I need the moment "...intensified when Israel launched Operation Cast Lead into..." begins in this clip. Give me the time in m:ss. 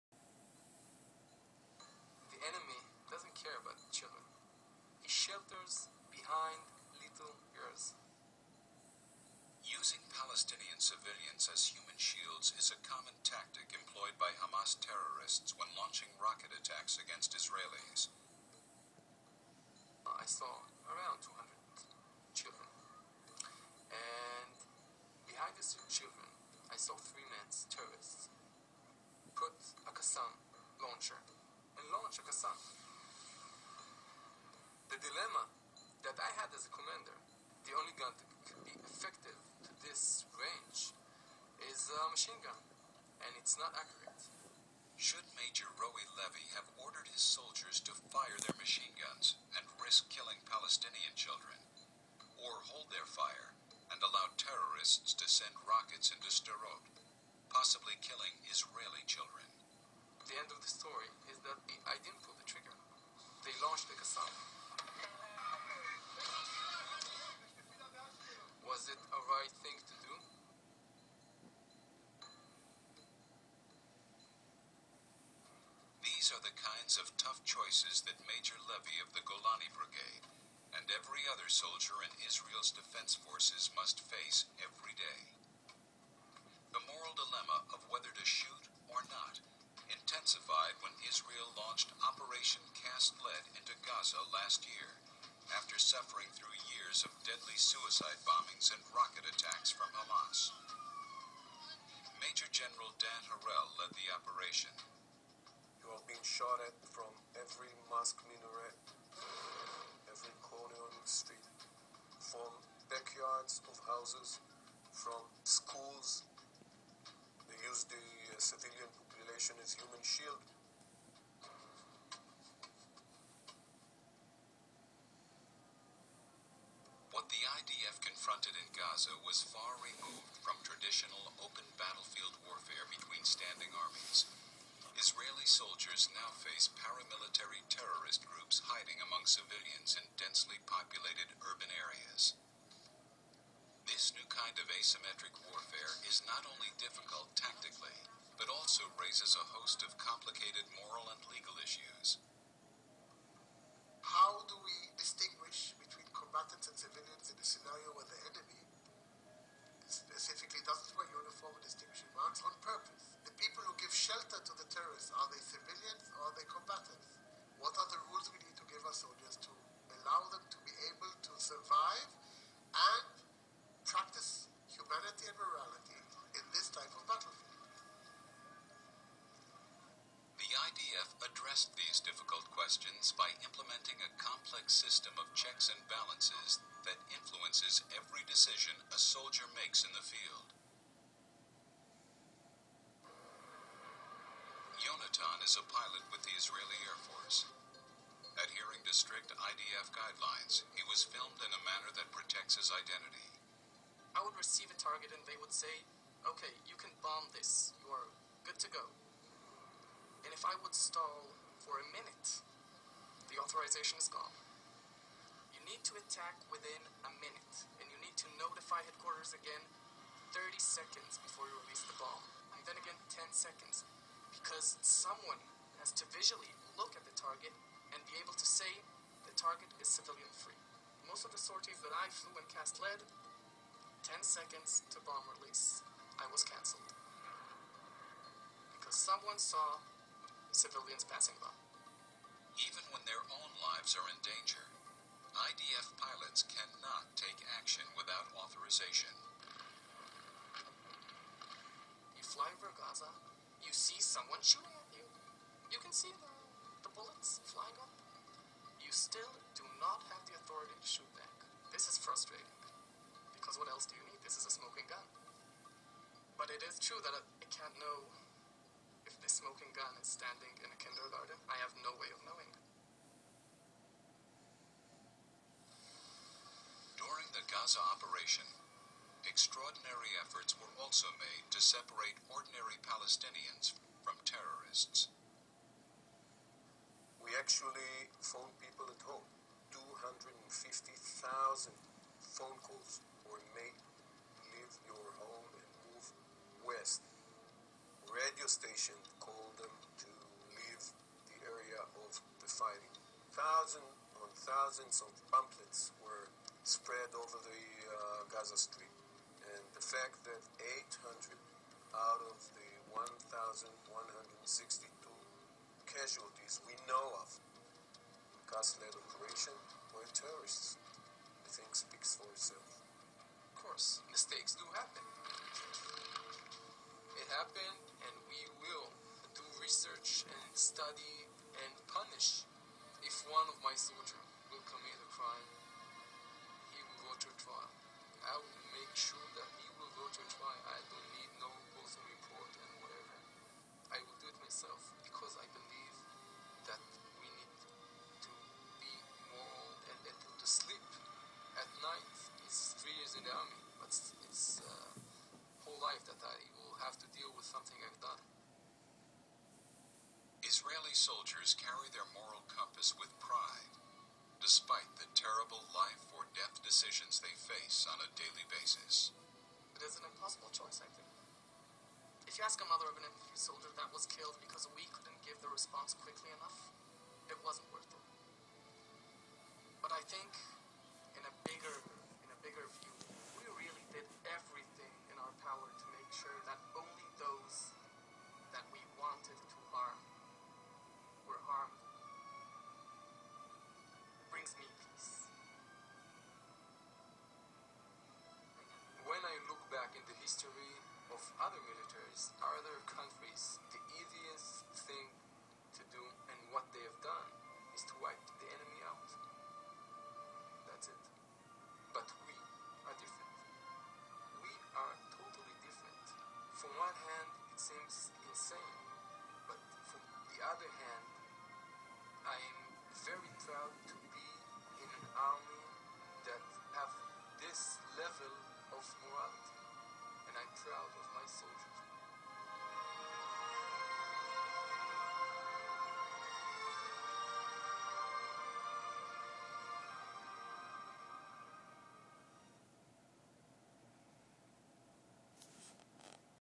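1:29.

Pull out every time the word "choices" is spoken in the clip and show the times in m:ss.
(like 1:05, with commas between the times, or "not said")
1:17, 6:10.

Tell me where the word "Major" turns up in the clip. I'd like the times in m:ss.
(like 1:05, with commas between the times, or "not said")
0:45, 1:18, 1:42.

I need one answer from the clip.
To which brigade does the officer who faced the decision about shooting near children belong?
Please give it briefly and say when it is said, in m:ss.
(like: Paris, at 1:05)
Golani Brigade, at 1:19.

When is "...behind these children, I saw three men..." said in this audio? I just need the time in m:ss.
0:25.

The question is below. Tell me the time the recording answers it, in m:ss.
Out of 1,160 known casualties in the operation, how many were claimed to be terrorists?
5:11.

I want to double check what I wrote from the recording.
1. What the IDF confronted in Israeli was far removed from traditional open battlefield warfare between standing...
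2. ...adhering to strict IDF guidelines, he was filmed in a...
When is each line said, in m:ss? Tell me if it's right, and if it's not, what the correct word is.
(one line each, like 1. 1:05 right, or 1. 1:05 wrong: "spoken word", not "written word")
1. 2:07 wrong: "Gaza", not "Israeli"
2. 3:18 right.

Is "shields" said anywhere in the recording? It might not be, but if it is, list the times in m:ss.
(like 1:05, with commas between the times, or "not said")
0:12, 2:00.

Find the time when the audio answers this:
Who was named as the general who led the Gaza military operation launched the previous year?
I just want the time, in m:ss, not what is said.
1:43.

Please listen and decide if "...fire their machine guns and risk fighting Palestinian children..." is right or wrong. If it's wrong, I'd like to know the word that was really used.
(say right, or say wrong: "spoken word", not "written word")
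wrong: "killing", not "fighting".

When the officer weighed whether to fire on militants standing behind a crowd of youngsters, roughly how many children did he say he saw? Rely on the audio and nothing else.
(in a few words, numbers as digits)
200.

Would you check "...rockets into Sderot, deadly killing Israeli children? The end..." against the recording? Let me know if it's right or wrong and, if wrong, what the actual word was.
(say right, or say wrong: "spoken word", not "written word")
wrong: "possibly", not "deadly".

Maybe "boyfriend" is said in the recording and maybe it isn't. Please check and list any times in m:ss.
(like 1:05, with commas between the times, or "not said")
not said.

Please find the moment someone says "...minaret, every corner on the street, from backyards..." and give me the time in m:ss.
1:48.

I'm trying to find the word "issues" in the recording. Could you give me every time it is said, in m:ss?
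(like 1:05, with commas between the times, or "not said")
2:31.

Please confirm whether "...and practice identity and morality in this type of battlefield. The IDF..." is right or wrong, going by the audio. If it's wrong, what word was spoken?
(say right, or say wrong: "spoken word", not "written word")
wrong: "humanity", not "identity".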